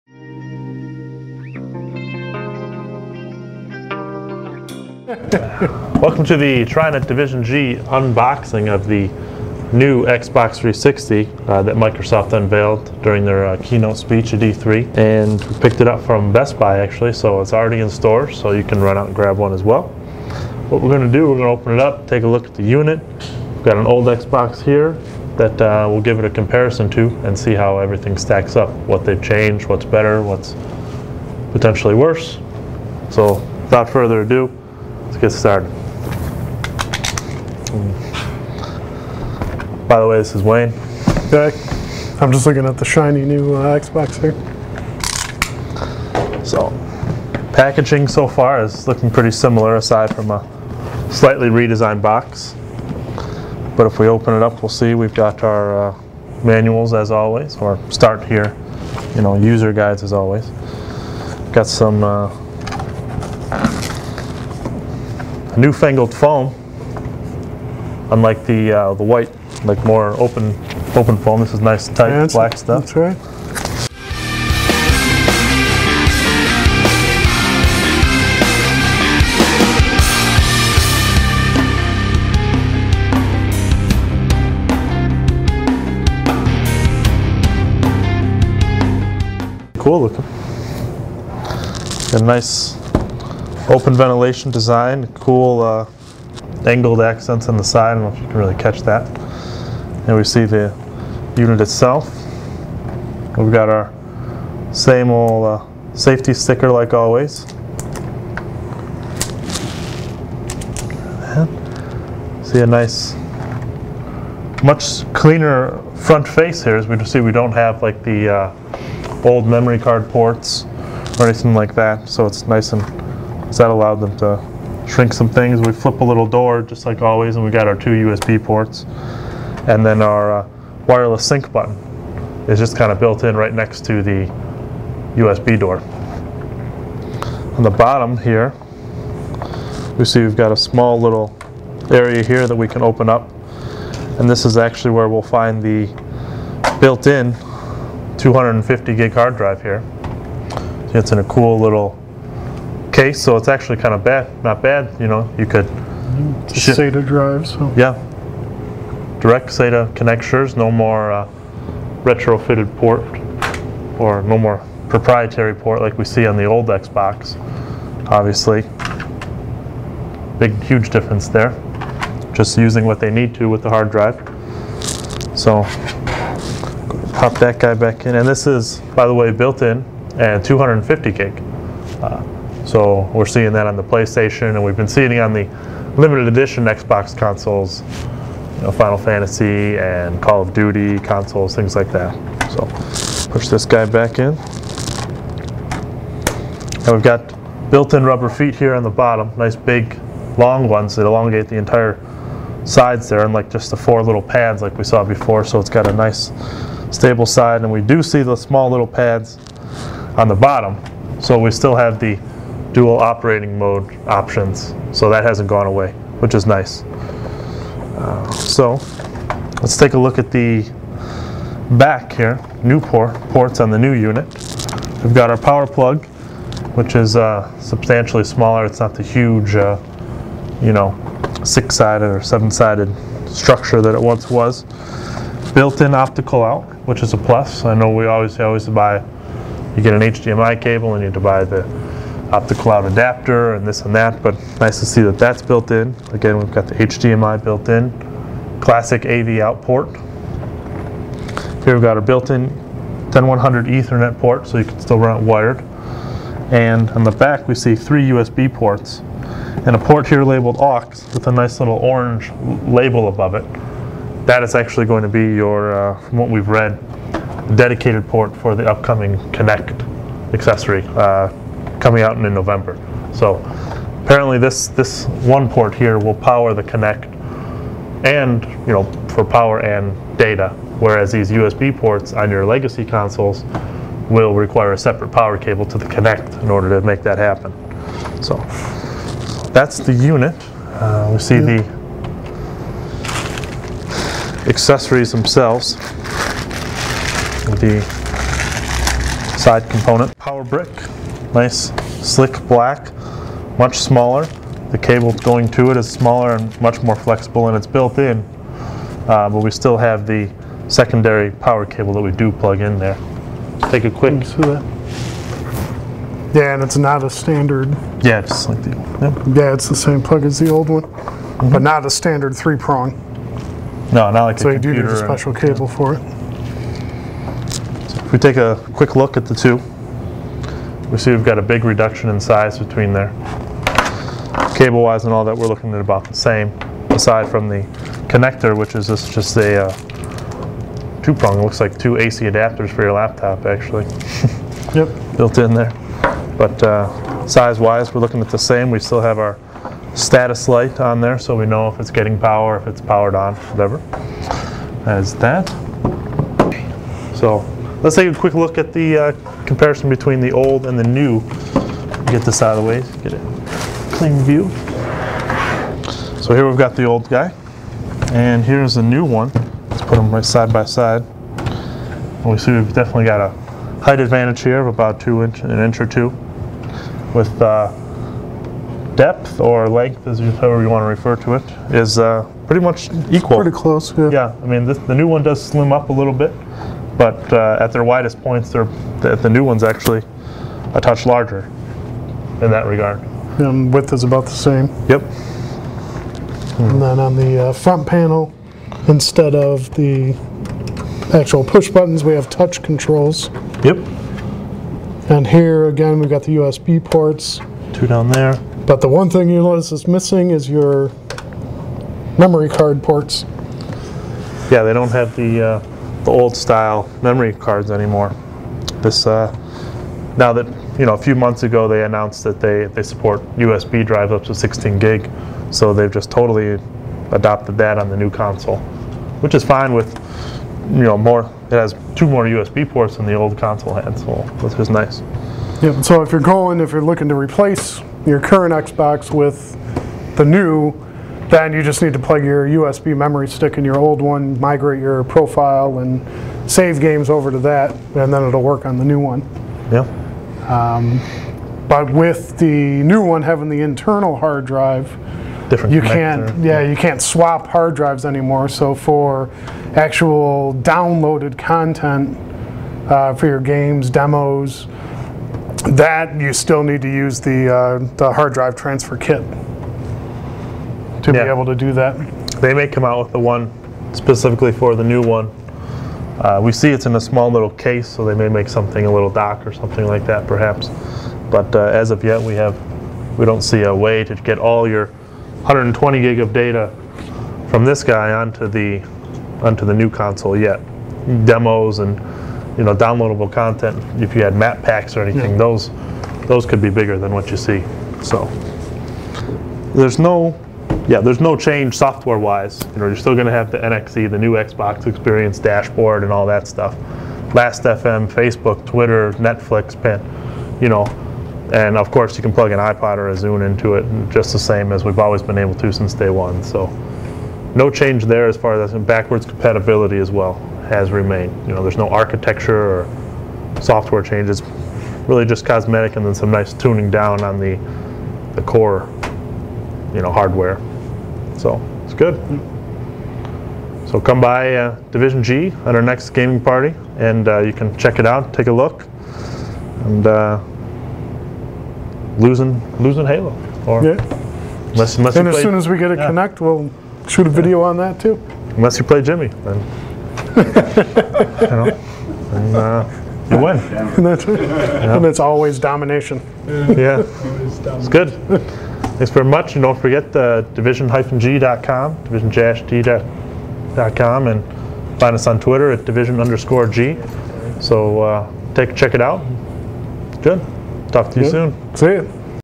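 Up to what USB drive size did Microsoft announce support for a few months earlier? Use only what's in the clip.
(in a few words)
16 gig.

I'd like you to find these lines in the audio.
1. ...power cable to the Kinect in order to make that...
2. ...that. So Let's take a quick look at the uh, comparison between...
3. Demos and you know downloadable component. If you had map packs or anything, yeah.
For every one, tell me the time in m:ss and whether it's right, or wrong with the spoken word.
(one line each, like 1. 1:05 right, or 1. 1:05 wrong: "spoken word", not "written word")
1. 4:45 right
2. 5:55 right
3. 8:11 wrong: "content", not "component".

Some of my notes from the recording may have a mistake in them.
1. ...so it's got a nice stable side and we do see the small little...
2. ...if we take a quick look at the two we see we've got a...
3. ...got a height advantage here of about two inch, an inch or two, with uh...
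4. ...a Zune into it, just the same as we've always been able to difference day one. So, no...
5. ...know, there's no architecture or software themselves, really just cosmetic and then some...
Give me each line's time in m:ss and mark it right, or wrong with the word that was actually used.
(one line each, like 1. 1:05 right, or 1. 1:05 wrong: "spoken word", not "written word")
1. 3:25 right
2. 5:28 right
3. 6:13 right
4. 8:33 wrong: "since", not "difference"
5. 8:41 wrong: "changes", not "themselves".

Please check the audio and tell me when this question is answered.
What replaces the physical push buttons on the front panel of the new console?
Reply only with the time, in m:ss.
6:42.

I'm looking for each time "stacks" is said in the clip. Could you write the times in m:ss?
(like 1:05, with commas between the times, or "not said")
0:28.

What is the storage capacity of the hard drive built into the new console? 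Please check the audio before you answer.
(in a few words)
250 gig.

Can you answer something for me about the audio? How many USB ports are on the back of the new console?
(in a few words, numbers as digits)
3.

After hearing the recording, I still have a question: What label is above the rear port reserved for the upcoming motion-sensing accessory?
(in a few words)
aux.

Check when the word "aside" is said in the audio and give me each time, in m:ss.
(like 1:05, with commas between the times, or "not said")
0:49, 5:36.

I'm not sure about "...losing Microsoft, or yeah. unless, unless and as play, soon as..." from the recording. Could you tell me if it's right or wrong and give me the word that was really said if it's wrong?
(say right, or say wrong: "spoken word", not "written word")
wrong: "Halo", not "Microsoft".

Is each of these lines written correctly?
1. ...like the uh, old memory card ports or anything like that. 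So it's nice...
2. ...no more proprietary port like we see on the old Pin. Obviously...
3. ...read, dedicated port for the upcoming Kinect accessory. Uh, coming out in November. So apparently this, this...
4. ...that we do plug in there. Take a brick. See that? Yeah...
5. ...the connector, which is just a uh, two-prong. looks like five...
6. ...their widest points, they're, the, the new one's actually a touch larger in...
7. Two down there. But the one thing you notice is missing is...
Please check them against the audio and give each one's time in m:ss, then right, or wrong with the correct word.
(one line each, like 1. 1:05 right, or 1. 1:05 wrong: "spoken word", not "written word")
1. 1:57 right
2. 2:44 wrong: "Xbox", not "Pin"
3. 4:26 right
4. 5:11 wrong: "quick", not "brick"
5. 5:37 wrong: "two", not "five"
6. 6:27 right
7. 6:47 right.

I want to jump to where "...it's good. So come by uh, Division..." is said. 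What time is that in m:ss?
8:51.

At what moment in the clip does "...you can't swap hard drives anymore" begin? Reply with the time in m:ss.
7:36.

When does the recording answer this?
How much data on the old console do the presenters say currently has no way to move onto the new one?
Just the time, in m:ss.
8:04.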